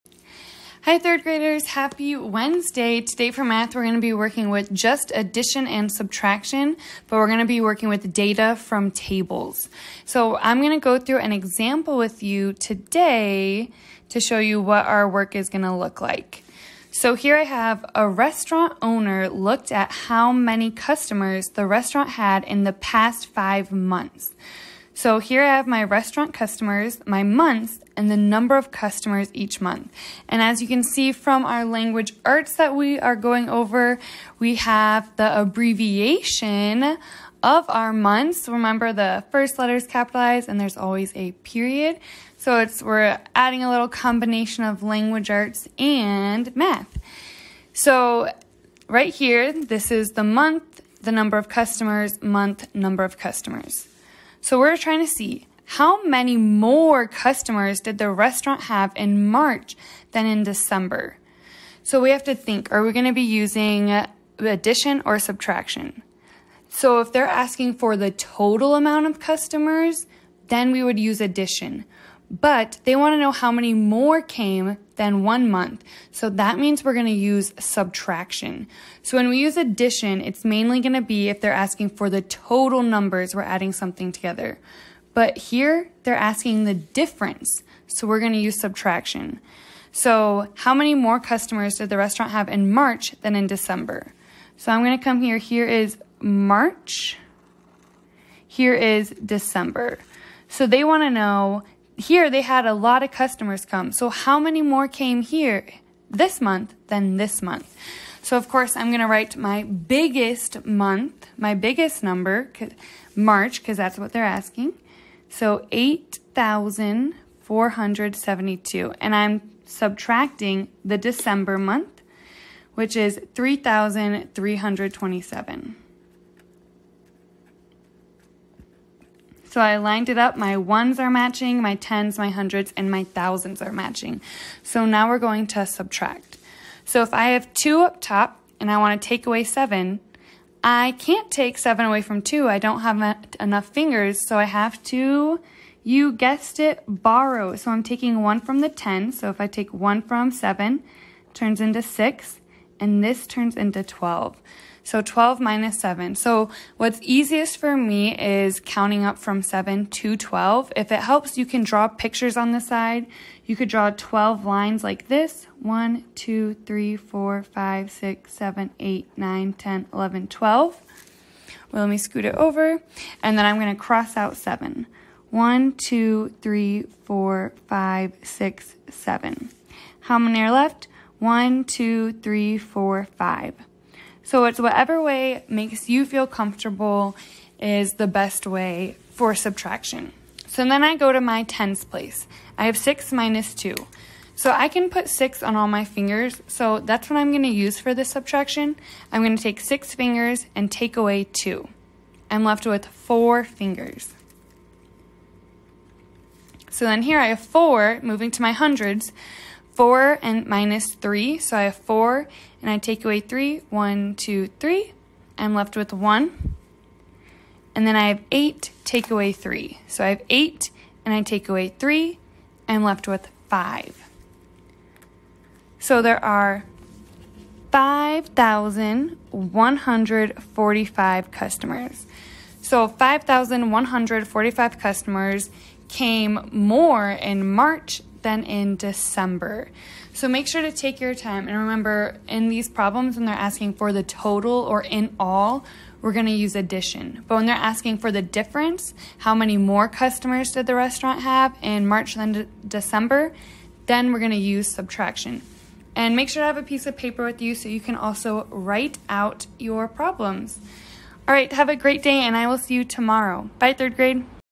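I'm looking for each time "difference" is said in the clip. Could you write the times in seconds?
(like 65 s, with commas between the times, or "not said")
86 s, 248 s.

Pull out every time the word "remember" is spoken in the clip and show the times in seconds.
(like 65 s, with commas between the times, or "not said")
38 s, 241 s.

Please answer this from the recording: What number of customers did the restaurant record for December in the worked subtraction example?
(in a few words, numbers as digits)
3,327.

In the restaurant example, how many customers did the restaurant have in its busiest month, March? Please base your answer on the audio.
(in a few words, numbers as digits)
8,472.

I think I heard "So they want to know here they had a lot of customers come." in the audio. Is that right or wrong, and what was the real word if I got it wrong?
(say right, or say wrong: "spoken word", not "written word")
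right.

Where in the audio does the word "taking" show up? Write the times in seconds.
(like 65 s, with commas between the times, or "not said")
147 s.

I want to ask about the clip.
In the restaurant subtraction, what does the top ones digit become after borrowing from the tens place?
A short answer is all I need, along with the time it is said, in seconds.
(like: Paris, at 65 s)
12, at 153 s.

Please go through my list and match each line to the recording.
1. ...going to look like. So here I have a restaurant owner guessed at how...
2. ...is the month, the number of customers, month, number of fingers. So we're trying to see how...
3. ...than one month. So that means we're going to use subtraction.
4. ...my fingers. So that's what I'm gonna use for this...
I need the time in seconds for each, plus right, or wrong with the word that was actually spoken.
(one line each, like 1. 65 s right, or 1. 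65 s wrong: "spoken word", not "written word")
1. 15 s wrong: "looked", not "guessed"
2. 49 s wrong: "customers", not "fingers"
3. 74 s right
4. 195 s right.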